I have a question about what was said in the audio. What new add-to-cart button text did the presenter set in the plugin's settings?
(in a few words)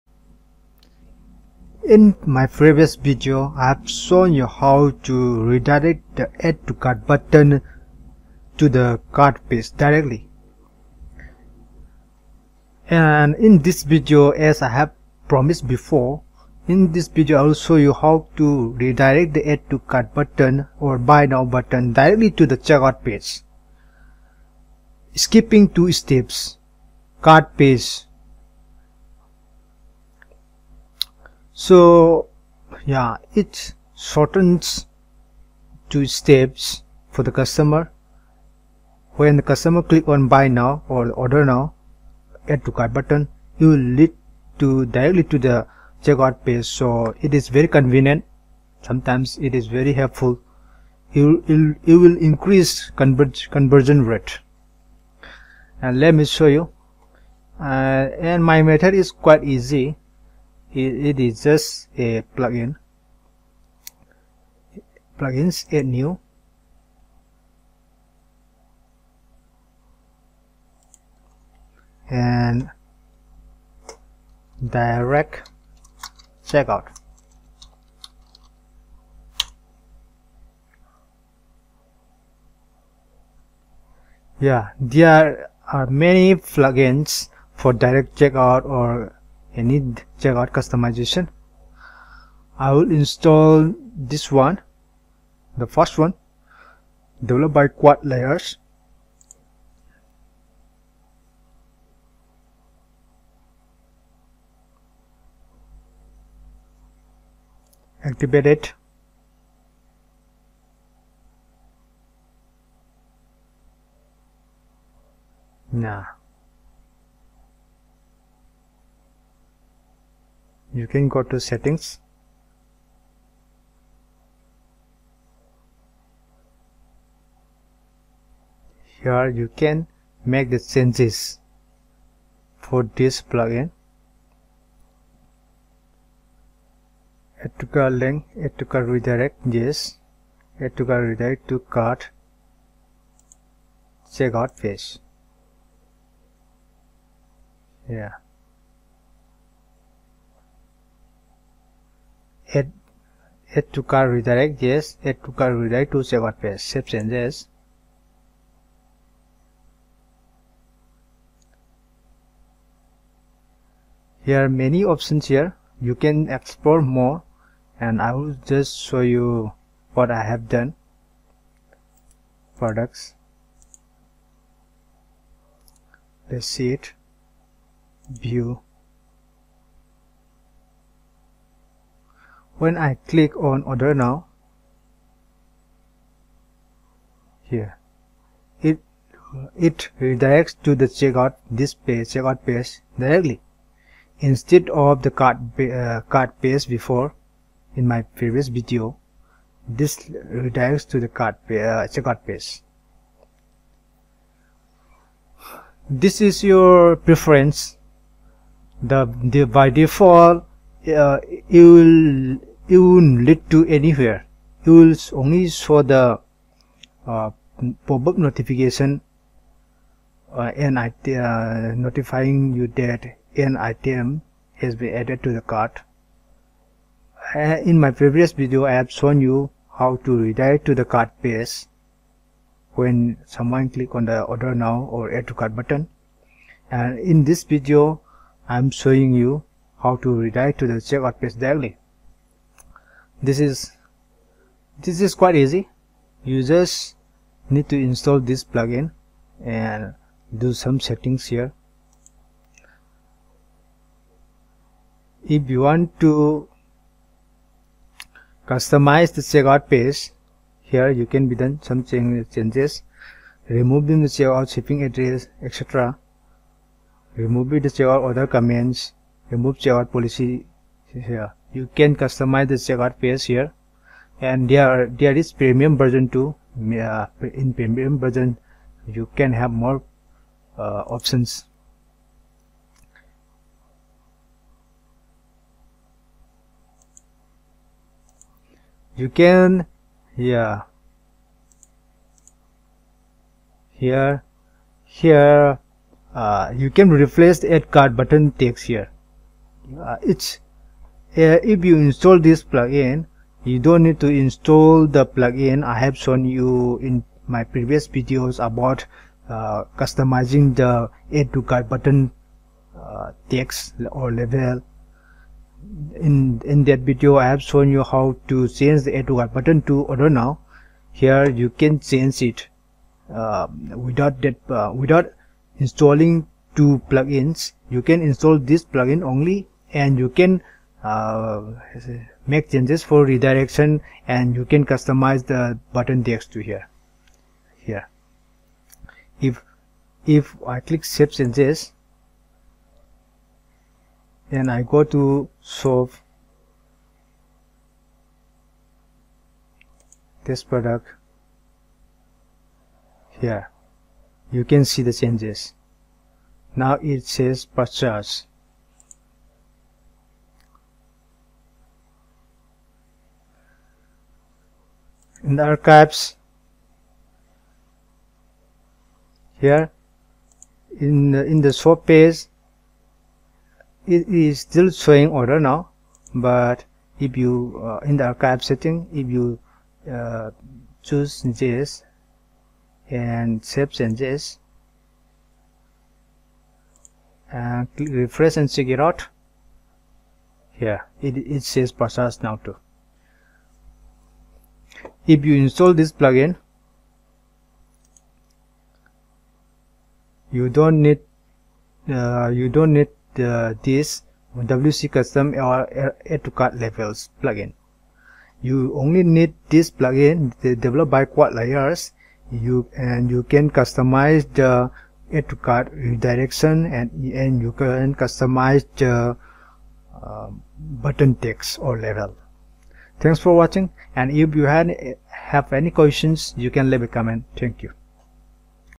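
Purchase.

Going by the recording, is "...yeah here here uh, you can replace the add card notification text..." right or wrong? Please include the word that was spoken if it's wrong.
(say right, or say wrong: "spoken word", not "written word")
wrong: "button", not "notification".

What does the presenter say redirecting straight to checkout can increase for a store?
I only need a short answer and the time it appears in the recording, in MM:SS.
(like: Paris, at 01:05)
Conversion rate, at 00:53.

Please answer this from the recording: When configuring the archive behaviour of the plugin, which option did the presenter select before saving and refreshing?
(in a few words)
JS.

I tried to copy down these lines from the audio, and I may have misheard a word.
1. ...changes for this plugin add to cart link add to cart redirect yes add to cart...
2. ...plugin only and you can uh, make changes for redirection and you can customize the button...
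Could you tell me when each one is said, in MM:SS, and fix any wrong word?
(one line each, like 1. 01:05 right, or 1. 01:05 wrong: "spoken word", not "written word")
1. 02:10 right
2. 05:28 right.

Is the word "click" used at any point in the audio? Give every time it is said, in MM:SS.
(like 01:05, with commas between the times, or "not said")
00:39, 03:03, 03:53, 05:40.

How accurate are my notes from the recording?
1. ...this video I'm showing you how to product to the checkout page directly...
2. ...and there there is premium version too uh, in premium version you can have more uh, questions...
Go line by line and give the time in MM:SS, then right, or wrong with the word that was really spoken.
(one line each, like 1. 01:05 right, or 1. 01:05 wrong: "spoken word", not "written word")
1. 03:57 wrong: "redirect", not "product"
2. 04:34 wrong: "options", not "questions".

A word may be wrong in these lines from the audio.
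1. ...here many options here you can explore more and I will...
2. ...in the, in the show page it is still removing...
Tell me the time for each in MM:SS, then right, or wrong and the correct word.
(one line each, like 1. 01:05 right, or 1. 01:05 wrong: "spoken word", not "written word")
1. 02:44 right
2. 06:10 wrong: "showing", not "removing".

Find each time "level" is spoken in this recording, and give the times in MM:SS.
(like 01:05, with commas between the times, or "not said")
05:14, 06:46, 07:01.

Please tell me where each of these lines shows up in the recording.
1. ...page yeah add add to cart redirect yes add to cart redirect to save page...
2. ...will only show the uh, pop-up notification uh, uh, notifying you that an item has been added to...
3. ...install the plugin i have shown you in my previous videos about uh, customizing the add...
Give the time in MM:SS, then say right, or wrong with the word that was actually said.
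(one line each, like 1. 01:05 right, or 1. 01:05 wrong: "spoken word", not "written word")
1. 02:24 right
2. 03:34 right
3. 05:04 right.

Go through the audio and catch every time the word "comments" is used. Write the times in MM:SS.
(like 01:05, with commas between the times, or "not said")
04:28, 07:06.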